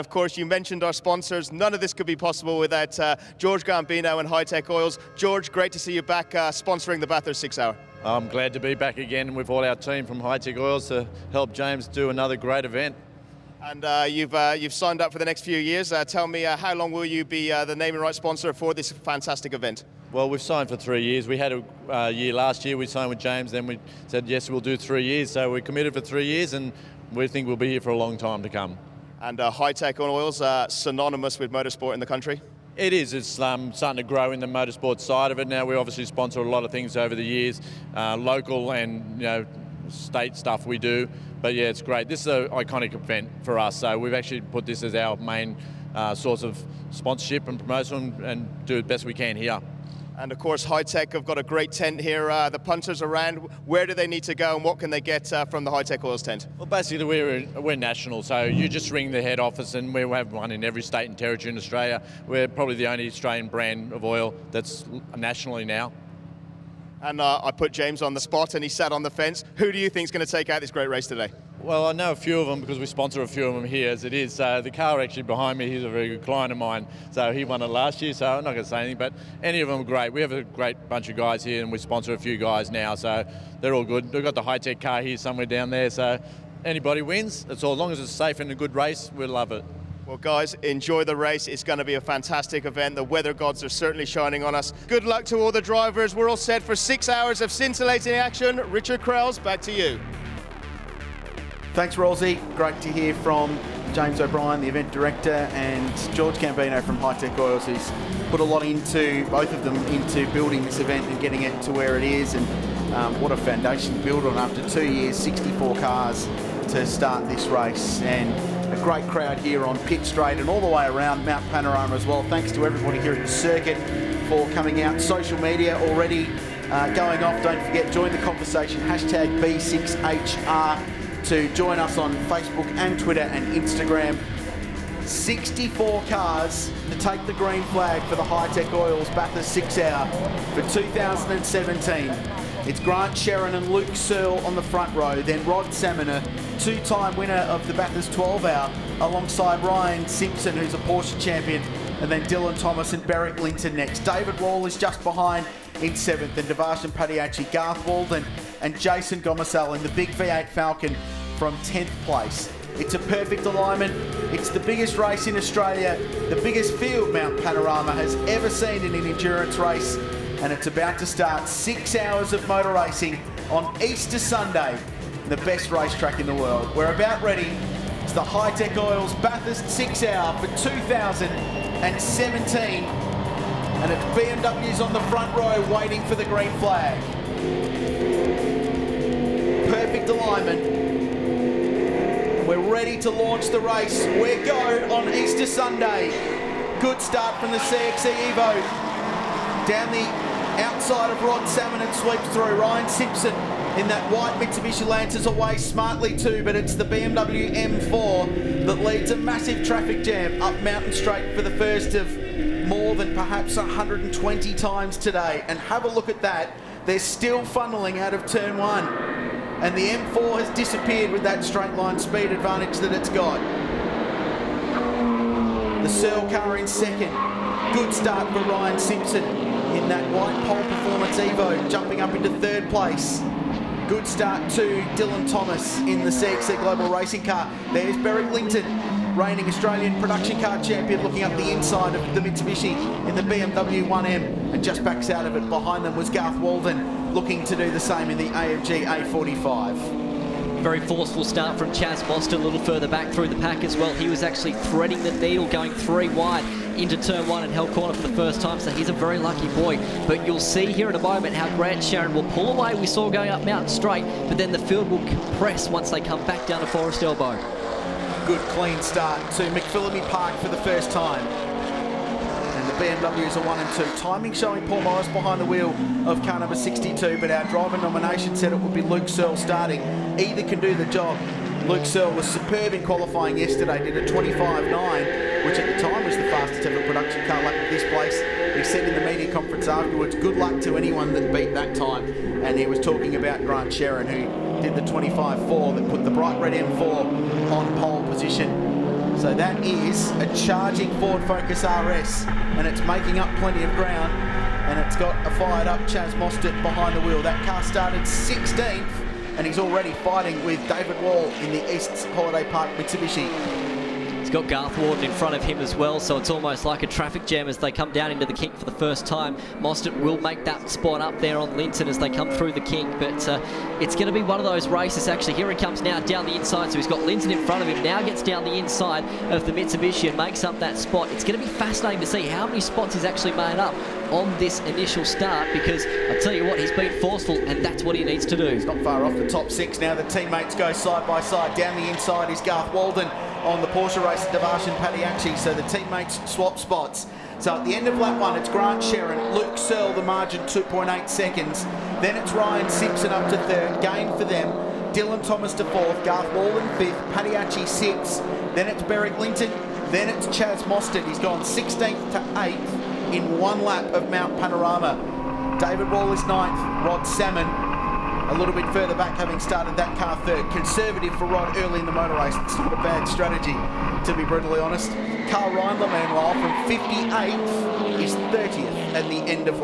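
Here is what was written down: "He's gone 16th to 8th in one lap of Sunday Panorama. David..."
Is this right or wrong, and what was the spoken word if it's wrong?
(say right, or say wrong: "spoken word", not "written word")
wrong: "Mount", not "Sunday".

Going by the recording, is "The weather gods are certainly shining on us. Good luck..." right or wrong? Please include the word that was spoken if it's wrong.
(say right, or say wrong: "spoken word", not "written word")
right.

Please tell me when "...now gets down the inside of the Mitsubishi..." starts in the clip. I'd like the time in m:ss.
5:27.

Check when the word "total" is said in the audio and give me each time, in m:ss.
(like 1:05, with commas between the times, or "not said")
not said.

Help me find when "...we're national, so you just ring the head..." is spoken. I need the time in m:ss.
0:57.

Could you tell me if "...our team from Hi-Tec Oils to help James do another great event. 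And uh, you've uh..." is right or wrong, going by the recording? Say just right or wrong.
right.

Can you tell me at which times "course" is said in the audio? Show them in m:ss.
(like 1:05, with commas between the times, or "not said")
0:00, 0:50.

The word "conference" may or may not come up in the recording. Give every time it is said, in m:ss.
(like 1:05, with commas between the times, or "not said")
4:49.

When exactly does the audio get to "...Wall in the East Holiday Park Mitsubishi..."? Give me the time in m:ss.
5:11.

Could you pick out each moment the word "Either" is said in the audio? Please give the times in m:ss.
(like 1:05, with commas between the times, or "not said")
4:40.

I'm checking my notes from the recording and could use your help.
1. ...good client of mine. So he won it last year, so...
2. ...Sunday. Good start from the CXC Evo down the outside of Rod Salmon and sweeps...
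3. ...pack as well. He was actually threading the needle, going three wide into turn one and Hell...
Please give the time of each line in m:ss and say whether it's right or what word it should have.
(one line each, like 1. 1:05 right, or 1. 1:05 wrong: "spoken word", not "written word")
1. 1:16 right
2. 3:15 right
3. 4:13 right.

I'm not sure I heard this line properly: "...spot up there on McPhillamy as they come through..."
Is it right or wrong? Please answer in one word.
wrong.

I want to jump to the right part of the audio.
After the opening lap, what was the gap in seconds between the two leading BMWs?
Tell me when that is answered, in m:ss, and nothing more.
5:50.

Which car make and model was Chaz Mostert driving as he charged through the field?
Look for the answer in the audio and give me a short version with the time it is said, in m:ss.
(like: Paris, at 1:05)
Ford Focus RS, at 5:00.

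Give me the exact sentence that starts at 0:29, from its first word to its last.
And uh, Hi-Tec on oils are synonymous with motorsport in the country.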